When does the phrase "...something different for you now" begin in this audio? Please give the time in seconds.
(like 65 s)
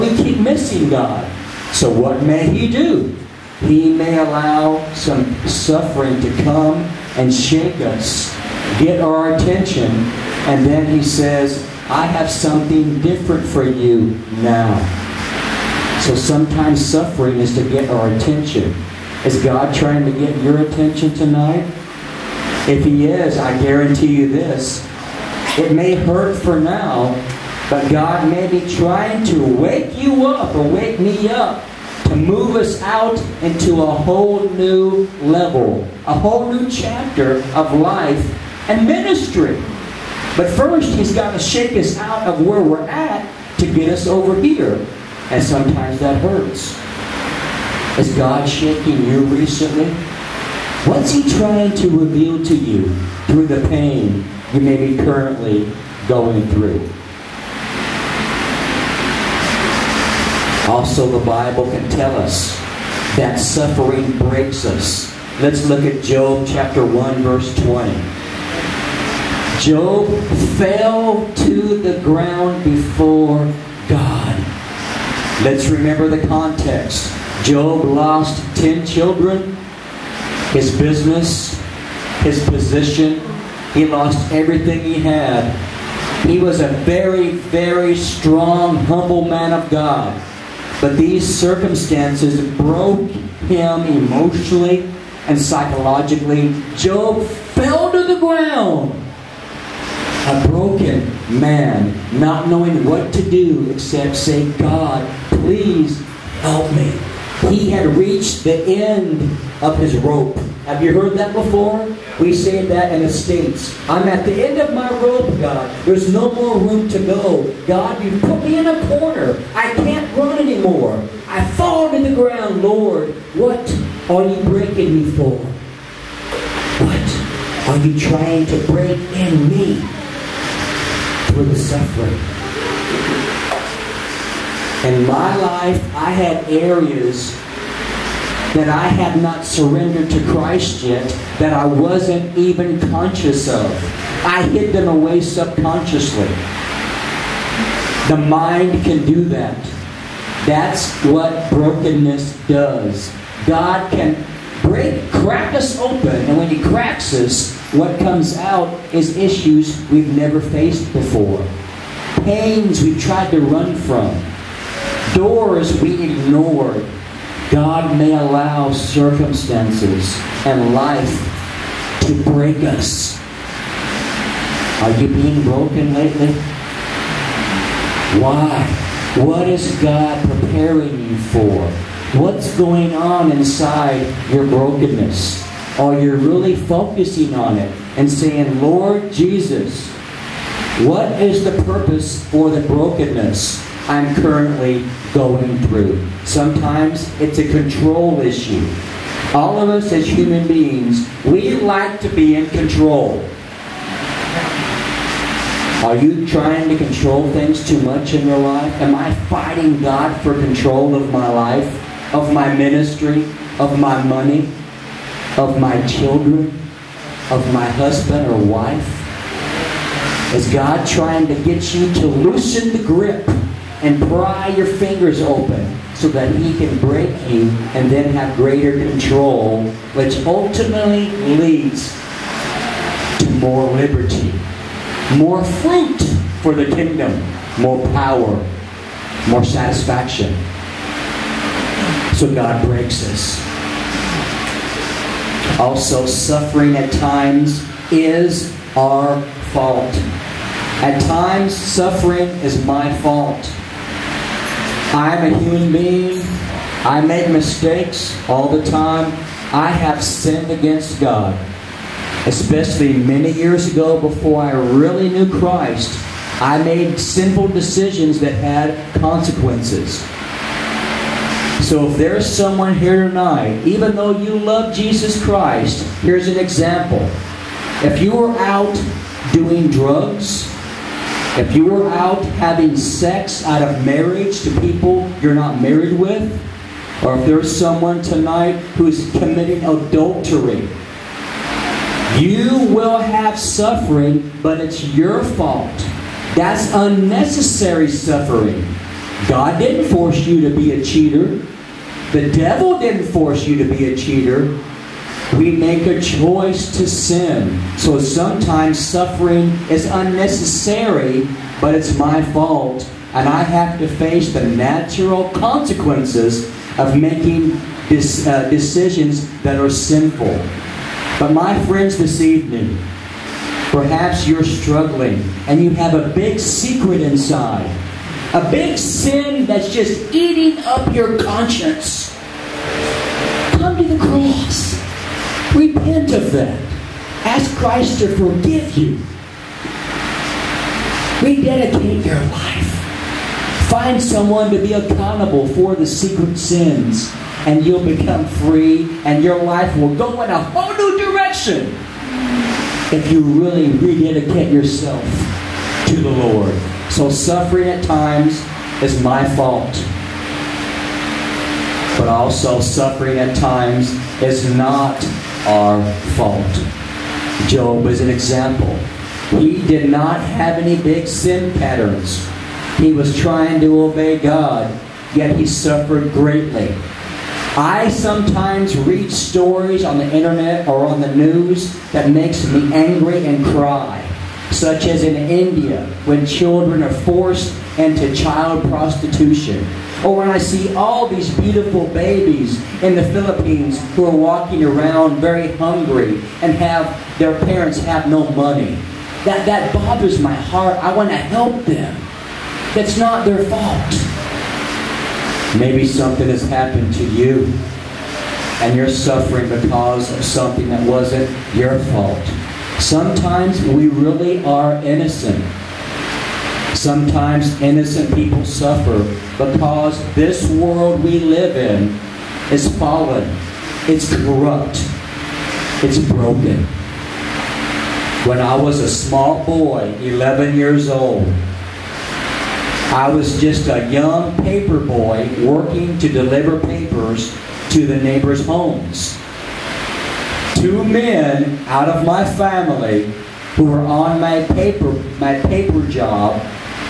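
12 s.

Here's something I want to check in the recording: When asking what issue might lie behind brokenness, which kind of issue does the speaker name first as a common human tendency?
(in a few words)
control issue.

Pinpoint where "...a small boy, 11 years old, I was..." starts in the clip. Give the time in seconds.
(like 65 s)
428 s.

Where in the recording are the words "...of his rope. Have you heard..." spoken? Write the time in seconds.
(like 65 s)
109 s.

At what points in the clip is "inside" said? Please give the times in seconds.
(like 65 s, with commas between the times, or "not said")
183 s, 327 s.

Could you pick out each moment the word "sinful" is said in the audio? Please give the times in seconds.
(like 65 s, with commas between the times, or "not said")
266 s, 319 s.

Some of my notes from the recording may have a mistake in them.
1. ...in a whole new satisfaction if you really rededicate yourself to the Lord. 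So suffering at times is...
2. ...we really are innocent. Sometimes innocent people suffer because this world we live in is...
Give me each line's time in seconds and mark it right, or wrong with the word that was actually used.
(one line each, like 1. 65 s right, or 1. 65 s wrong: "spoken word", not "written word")
1. 350 s wrong: "direction", not "satisfaction"
2. 413 s right.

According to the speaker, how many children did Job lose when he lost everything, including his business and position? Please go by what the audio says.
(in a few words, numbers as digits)
10.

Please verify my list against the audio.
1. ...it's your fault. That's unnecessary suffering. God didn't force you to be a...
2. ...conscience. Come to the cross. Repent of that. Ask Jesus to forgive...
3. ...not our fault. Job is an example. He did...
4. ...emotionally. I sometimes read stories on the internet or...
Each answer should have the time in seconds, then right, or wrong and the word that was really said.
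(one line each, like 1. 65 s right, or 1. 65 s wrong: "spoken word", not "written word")
1. 294 s right
2. 331 s wrong: "Christ", not "Jesus"
3. 364 s right
4. 376 s wrong: "greatly", not "emotionally".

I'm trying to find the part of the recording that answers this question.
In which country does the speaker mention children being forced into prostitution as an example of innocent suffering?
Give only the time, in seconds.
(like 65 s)
385 s.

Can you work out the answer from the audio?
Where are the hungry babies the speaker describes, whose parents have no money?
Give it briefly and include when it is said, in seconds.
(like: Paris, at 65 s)
the Philippines, at 393 s.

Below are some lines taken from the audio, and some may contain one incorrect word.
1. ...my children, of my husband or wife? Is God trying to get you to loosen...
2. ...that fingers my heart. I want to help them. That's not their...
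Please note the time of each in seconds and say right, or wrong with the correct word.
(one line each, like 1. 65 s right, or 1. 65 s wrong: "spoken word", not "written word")
1. 215 s right
2. 399 s wrong: "bothers", not "fingers".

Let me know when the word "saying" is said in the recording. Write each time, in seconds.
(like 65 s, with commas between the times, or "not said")
188 s.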